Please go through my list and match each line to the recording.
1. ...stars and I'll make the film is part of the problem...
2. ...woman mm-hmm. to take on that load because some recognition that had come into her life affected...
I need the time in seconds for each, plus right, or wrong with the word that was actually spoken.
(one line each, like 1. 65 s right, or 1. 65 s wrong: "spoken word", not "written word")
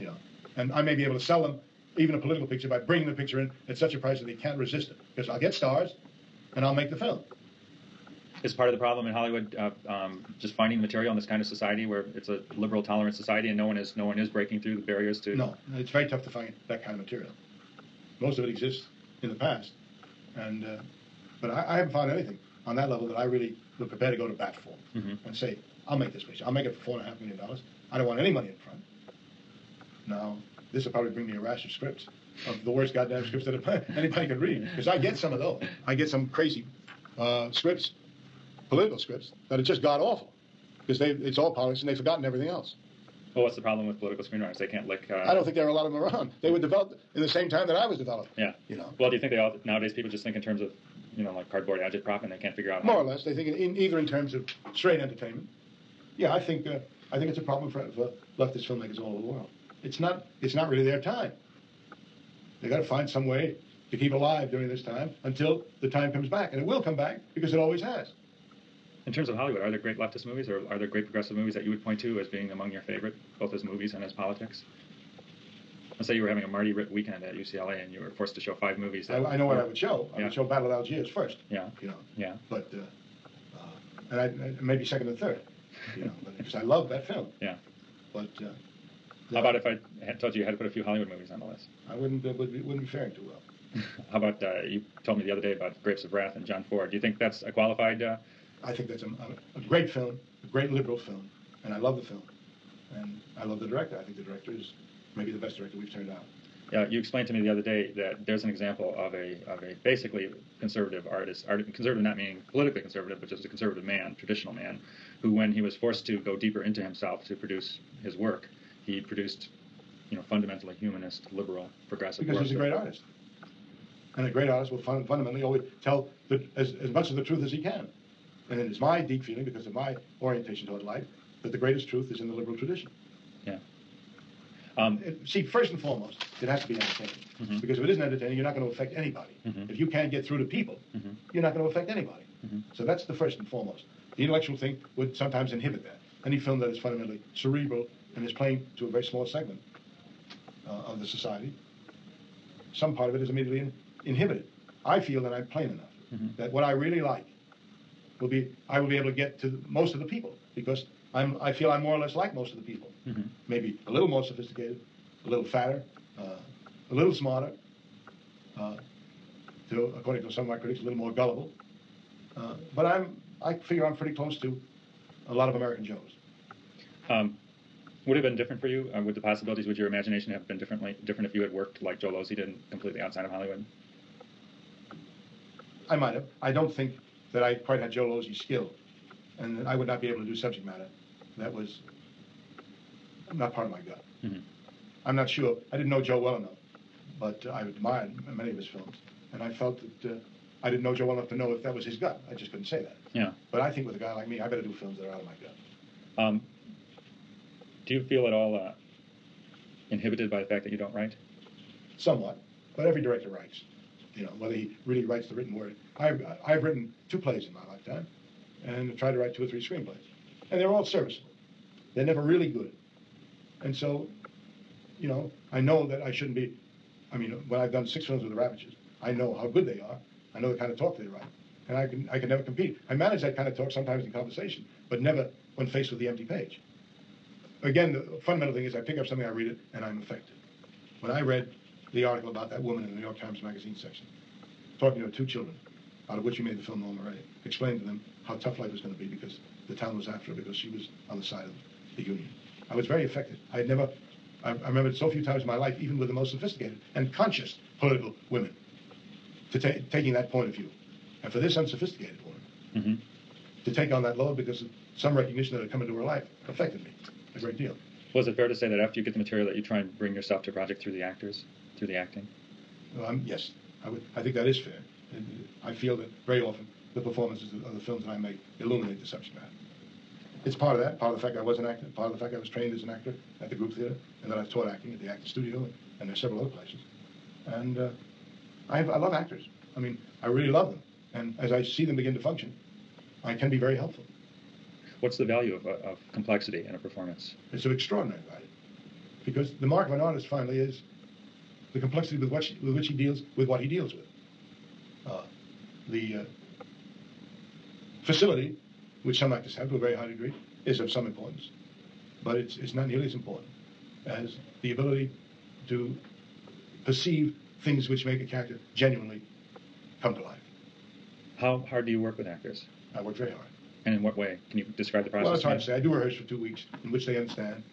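1. 5 s right
2. 262 s right.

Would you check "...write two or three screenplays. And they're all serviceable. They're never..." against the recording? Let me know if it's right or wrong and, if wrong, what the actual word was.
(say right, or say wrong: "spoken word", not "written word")
right.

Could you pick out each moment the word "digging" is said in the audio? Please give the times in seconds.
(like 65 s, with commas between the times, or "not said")
not said.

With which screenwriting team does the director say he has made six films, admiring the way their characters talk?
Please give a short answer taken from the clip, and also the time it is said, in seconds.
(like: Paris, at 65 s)
the Ravetches, at 228 s.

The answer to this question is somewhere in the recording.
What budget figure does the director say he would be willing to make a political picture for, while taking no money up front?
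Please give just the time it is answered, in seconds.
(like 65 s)
26 s.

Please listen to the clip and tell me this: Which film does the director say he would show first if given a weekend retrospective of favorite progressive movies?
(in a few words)
Battle of Algiers.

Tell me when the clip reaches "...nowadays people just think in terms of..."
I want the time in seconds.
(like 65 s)
49 s.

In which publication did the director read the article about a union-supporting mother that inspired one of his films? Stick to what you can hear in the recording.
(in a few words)
New York Times Magazine.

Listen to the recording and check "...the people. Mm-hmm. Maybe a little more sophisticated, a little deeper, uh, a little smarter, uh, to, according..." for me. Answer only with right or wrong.
wrong.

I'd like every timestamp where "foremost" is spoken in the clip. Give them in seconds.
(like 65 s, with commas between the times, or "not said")
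135 s, 143 s.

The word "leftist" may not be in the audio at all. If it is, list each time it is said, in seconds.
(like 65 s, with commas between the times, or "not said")
58 s, 69 s.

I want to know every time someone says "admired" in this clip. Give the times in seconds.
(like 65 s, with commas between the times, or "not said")
197 s.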